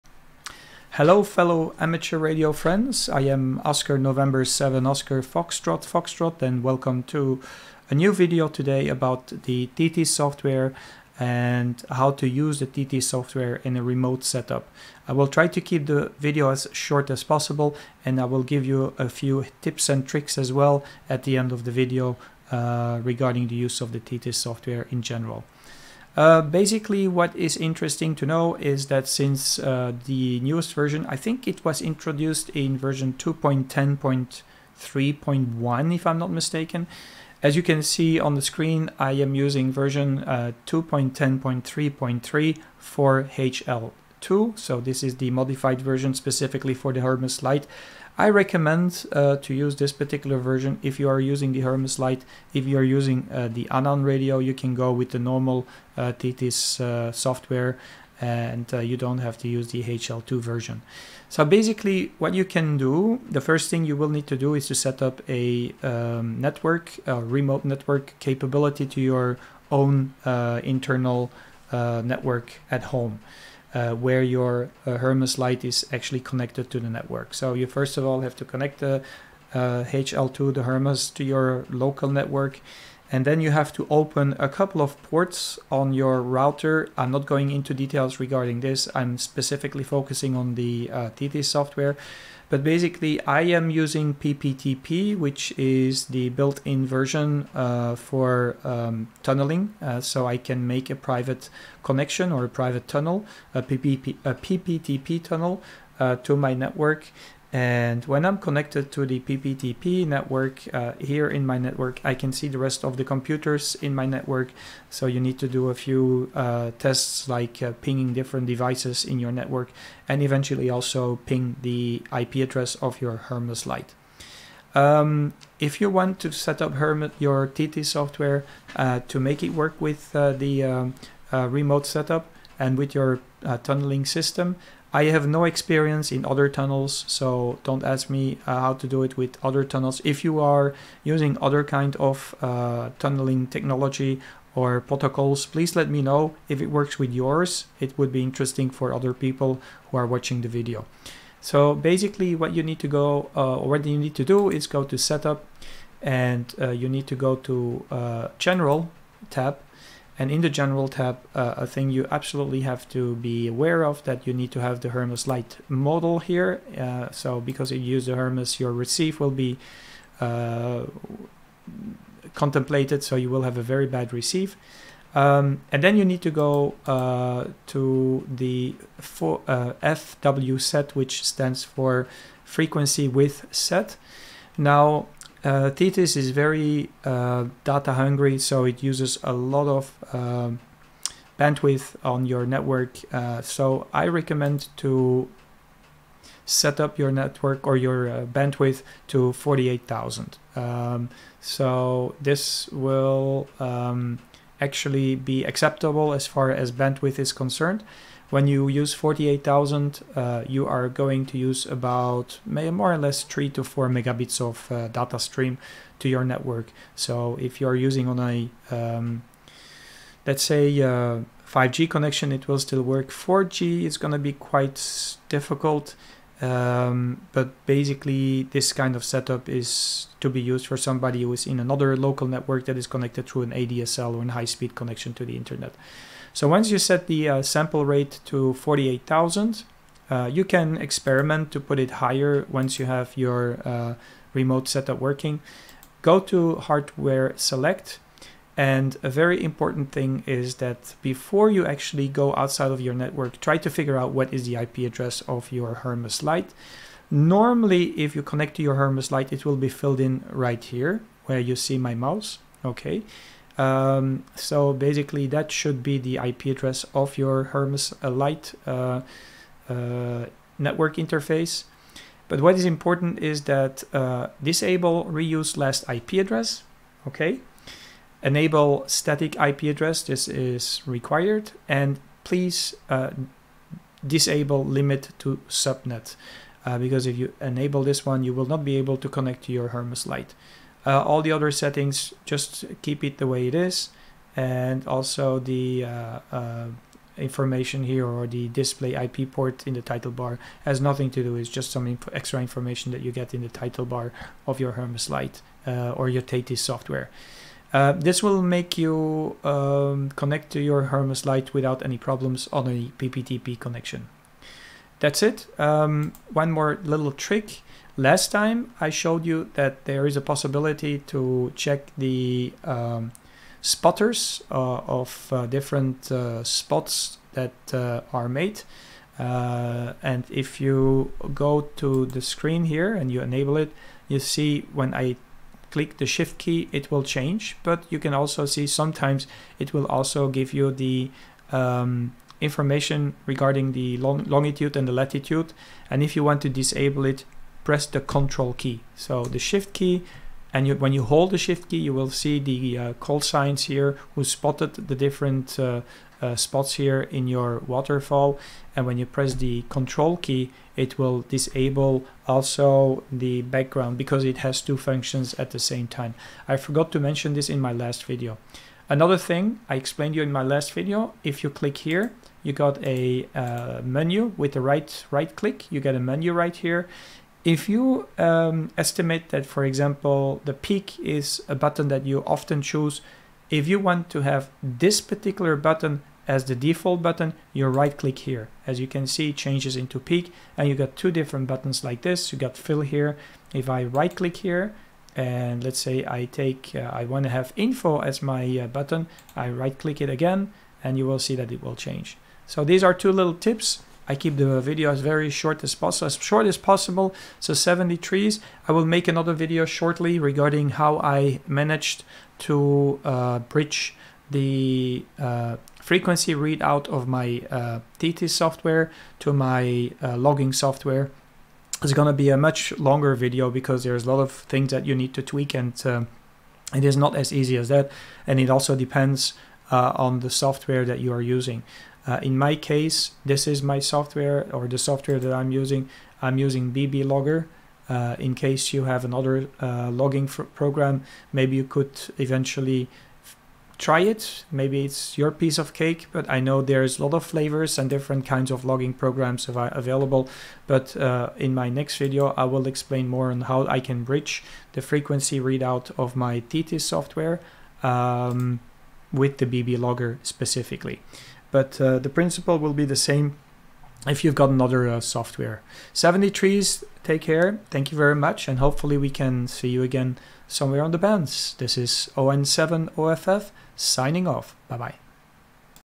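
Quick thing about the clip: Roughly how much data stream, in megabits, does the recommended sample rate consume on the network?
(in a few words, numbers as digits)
3 to 4 megabits.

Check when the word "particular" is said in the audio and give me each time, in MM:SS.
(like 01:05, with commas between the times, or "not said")
00:49, 06:25.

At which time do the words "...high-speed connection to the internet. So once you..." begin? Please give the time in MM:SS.
03:54.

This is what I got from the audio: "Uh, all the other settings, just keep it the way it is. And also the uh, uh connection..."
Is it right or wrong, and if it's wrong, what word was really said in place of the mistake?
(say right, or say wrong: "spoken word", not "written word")
wrong: "information", not "connection".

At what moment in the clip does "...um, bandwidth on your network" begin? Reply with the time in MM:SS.
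03:10.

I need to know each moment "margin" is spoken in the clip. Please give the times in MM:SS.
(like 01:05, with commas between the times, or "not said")
not said.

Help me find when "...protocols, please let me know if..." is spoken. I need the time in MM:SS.
02:24.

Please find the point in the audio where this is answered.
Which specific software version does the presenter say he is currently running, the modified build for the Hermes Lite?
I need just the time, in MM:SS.
00:40.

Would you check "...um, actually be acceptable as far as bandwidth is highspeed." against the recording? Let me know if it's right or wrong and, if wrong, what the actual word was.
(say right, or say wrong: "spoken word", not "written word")
wrong: "concerned", not "highspeed".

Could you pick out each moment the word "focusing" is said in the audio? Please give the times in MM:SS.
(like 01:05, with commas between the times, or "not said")
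01:29.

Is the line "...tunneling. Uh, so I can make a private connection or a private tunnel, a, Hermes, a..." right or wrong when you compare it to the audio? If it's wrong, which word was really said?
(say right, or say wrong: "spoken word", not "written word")
wrong: "PPP", not "Hermes".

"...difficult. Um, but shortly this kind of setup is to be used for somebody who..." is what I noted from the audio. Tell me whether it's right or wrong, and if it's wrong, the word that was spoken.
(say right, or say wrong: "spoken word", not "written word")
wrong: "basically", not "shortly".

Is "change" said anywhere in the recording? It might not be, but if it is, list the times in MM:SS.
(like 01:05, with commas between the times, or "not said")
05:37, 06:29, 06:41.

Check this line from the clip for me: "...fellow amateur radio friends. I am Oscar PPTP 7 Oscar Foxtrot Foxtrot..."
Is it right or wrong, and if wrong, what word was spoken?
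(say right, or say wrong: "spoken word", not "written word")
wrong: "November", not "PPTP".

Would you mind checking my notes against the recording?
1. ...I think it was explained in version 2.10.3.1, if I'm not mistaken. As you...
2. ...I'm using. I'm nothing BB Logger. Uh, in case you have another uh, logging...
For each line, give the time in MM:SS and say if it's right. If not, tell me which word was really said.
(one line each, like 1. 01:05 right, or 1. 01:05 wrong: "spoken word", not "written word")
1. 00:31 wrong: "introduced", not "explained"
2. 07:15 wrong: "using", not "nothing".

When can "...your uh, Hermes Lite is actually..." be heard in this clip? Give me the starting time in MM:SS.
01:14.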